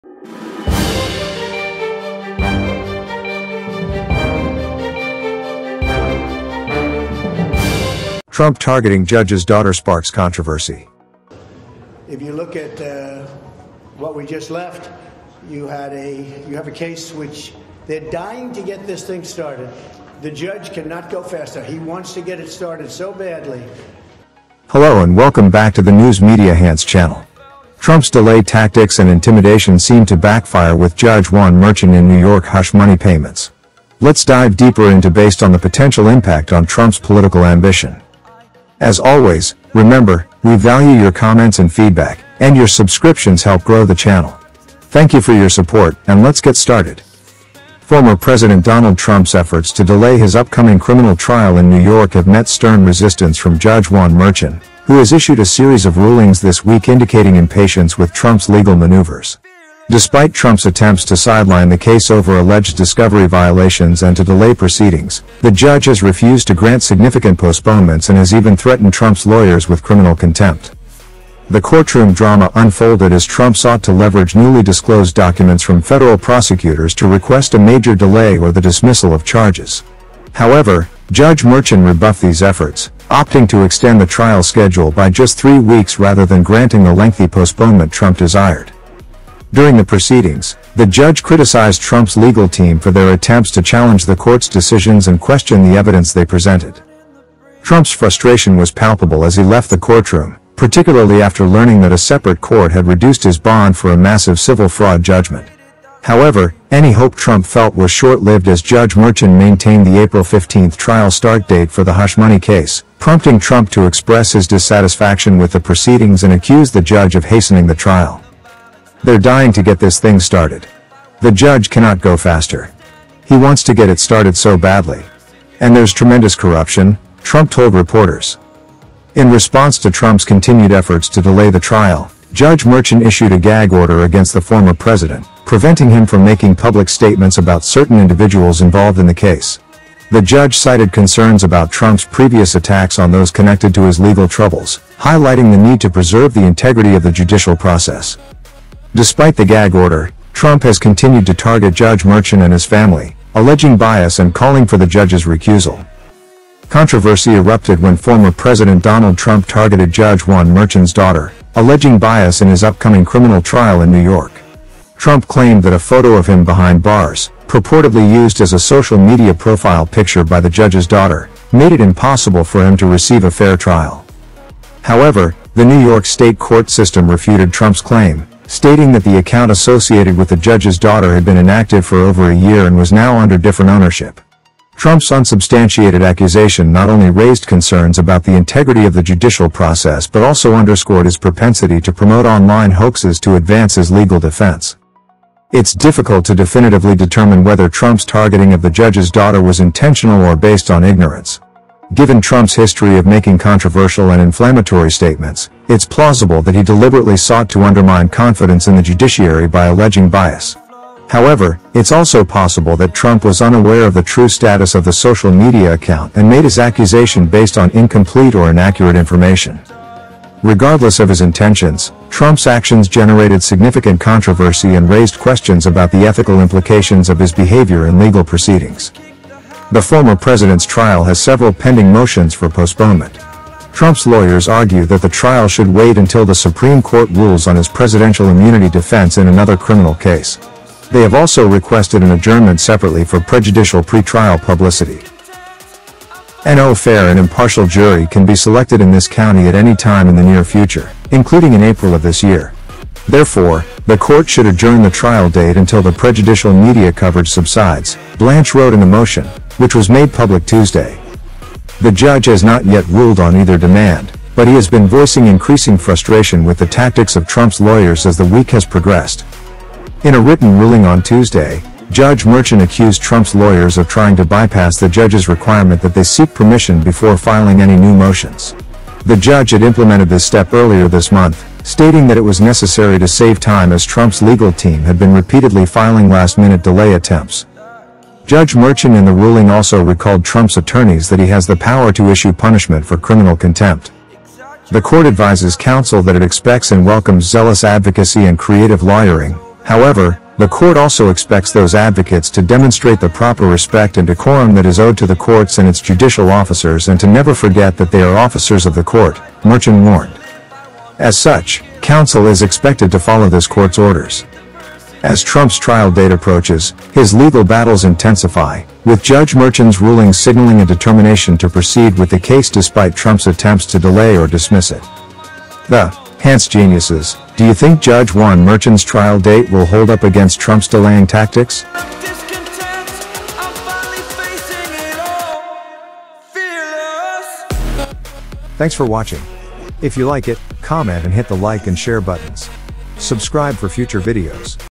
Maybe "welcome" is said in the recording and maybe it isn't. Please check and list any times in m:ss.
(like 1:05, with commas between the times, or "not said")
0:25, 4:56.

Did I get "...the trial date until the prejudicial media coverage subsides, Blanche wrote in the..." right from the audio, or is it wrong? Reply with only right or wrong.
right.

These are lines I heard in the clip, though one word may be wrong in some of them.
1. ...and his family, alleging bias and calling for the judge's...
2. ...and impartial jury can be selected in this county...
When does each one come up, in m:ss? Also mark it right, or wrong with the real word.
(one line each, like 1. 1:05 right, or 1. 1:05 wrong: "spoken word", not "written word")
1. 2:32 right
2. 4:07 right.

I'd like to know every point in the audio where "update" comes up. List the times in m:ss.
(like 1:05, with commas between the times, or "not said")
not said.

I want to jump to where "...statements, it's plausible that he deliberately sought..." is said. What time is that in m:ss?
3:24.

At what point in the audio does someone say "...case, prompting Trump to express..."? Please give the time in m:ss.
1:52.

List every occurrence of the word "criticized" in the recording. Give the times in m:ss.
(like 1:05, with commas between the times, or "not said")
1:31.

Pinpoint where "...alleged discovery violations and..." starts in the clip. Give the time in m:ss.
1:02.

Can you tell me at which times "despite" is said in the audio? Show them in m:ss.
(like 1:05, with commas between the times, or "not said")
0:59, 2:28, 5:22.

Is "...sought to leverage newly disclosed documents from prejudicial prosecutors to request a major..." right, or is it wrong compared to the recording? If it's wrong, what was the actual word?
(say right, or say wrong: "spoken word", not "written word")
wrong: "federal", not "prejudicial".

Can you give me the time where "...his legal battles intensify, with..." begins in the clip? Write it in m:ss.
5:16.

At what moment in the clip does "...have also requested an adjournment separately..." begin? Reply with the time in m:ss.
4:01.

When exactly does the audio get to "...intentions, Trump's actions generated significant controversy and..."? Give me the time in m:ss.
3:41.